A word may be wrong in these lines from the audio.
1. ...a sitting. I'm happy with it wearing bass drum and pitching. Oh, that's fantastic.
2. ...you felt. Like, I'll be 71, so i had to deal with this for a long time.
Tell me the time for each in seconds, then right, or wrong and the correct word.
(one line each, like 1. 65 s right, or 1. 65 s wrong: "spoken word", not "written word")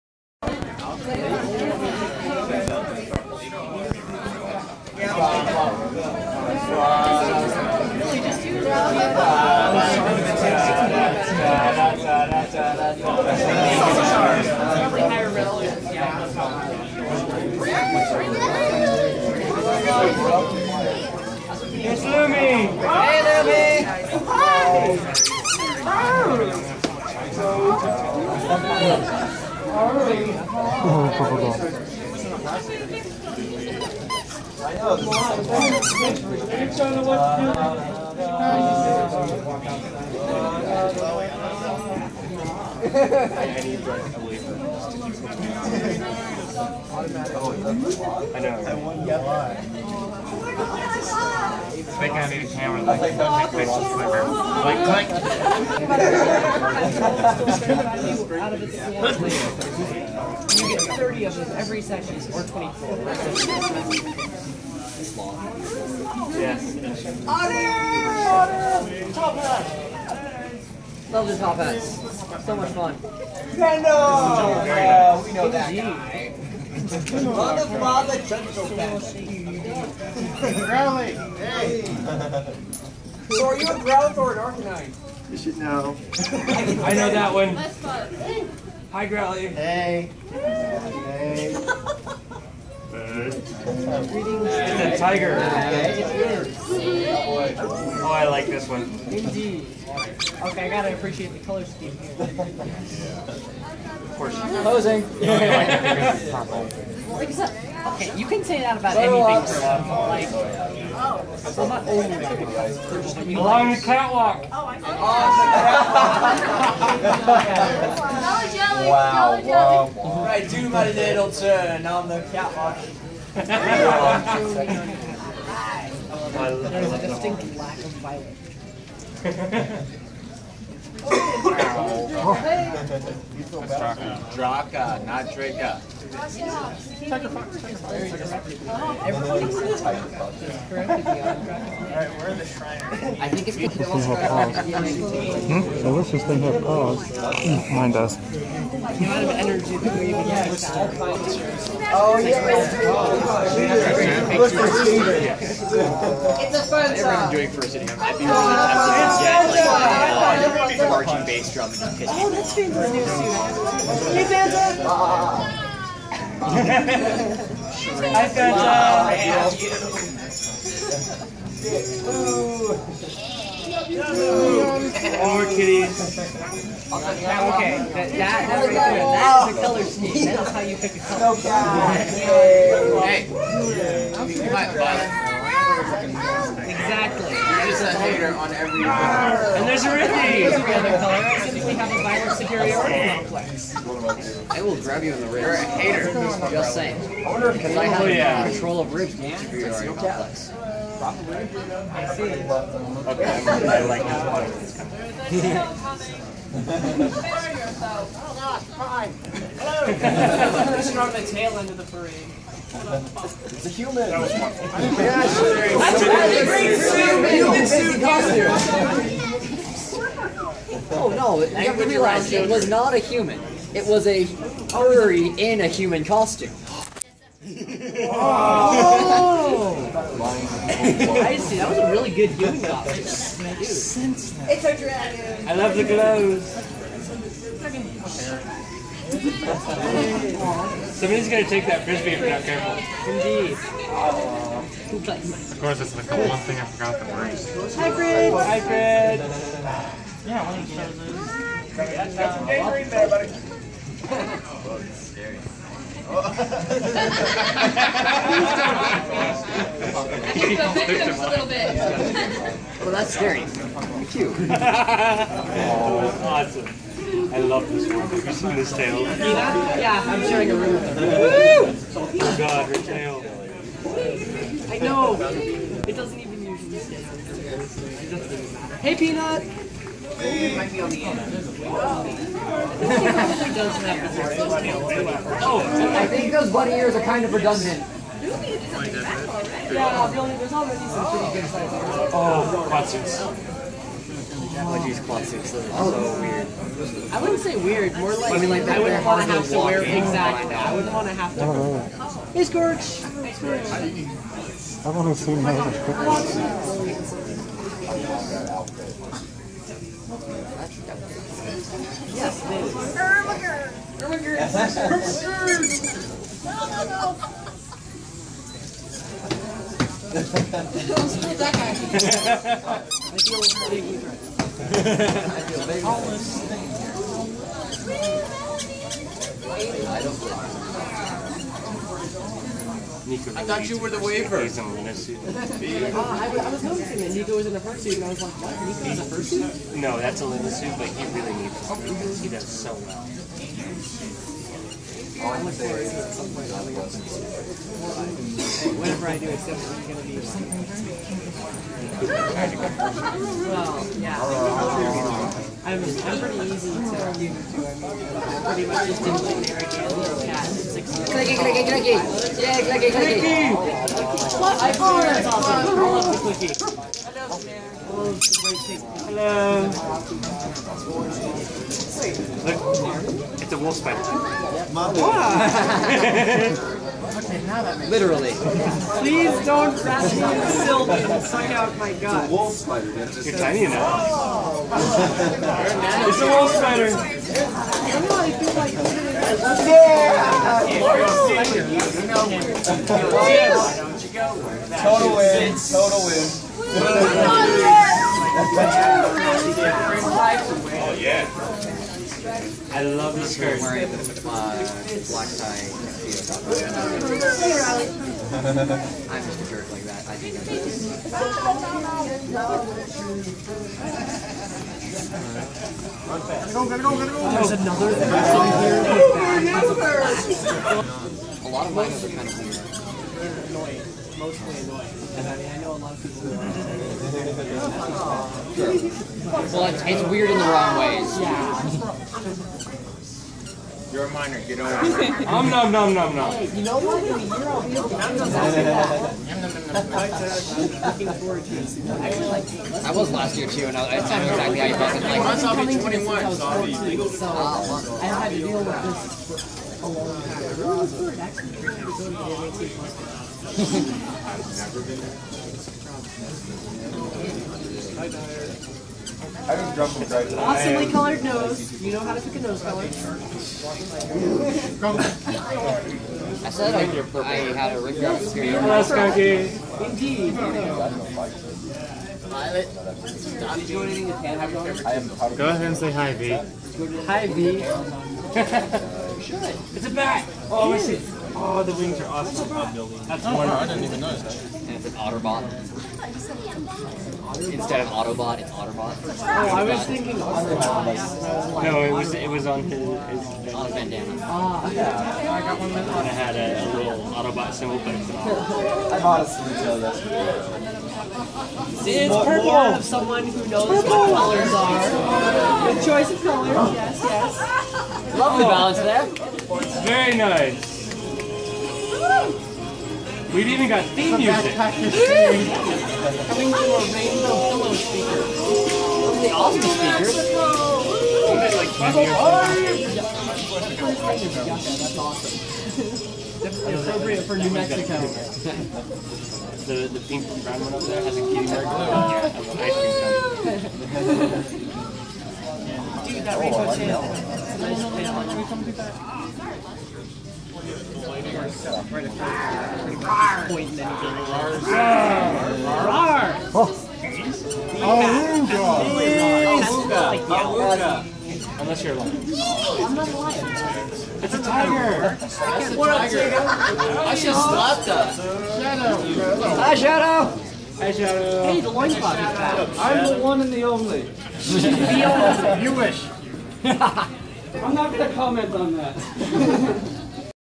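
1. 157 s wrong: "charging", not "wearing"
2. 444 s wrong: "21", not "71".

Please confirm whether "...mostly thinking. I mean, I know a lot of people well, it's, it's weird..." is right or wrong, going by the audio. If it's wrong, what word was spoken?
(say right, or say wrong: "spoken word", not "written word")
wrong: "annoying", not "thinking".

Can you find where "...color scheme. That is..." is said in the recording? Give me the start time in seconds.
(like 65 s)
179 s.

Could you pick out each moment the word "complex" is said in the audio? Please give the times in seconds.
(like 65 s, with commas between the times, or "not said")
193 s, 199 s.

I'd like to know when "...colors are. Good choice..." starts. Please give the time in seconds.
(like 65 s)
503 s.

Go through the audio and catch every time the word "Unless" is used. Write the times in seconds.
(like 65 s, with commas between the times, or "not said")
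145 s, 551 s.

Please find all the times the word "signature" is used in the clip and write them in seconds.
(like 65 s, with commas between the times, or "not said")
not said.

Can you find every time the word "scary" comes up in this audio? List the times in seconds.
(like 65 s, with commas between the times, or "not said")
254 s, 263 s.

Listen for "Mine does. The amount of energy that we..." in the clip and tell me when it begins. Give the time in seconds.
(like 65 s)
147 s.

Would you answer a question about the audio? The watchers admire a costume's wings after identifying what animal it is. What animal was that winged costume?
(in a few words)
Bat.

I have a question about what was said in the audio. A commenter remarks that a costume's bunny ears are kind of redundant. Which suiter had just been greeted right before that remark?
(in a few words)
Peanut.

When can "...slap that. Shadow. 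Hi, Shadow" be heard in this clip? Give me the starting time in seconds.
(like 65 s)
557 s.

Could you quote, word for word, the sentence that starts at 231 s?
That was a really good human costume.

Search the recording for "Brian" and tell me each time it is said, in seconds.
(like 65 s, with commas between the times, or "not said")
not said.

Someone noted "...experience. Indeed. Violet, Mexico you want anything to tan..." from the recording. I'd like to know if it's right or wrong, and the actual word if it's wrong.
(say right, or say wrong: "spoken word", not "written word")
wrong: "Did", not "Mexico".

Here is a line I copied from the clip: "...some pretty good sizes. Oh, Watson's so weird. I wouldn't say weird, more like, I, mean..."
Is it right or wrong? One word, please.
right.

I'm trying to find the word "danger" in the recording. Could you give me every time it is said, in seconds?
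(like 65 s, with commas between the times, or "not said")
252 s.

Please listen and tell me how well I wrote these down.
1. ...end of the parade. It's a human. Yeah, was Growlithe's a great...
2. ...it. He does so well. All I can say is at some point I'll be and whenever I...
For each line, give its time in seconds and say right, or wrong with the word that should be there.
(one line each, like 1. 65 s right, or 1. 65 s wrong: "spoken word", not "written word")
1. 211 s wrong: "That", not "Growlithe"
2. 342 s right.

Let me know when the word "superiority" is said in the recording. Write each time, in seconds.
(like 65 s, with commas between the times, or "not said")
192 s, 199 s.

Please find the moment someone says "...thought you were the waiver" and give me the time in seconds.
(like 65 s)
333 s.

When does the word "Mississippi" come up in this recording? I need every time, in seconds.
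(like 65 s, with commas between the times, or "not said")
not said.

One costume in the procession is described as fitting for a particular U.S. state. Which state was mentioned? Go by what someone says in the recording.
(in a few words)
New Mexico.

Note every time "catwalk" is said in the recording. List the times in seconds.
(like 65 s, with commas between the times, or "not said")
113 s, 122 s.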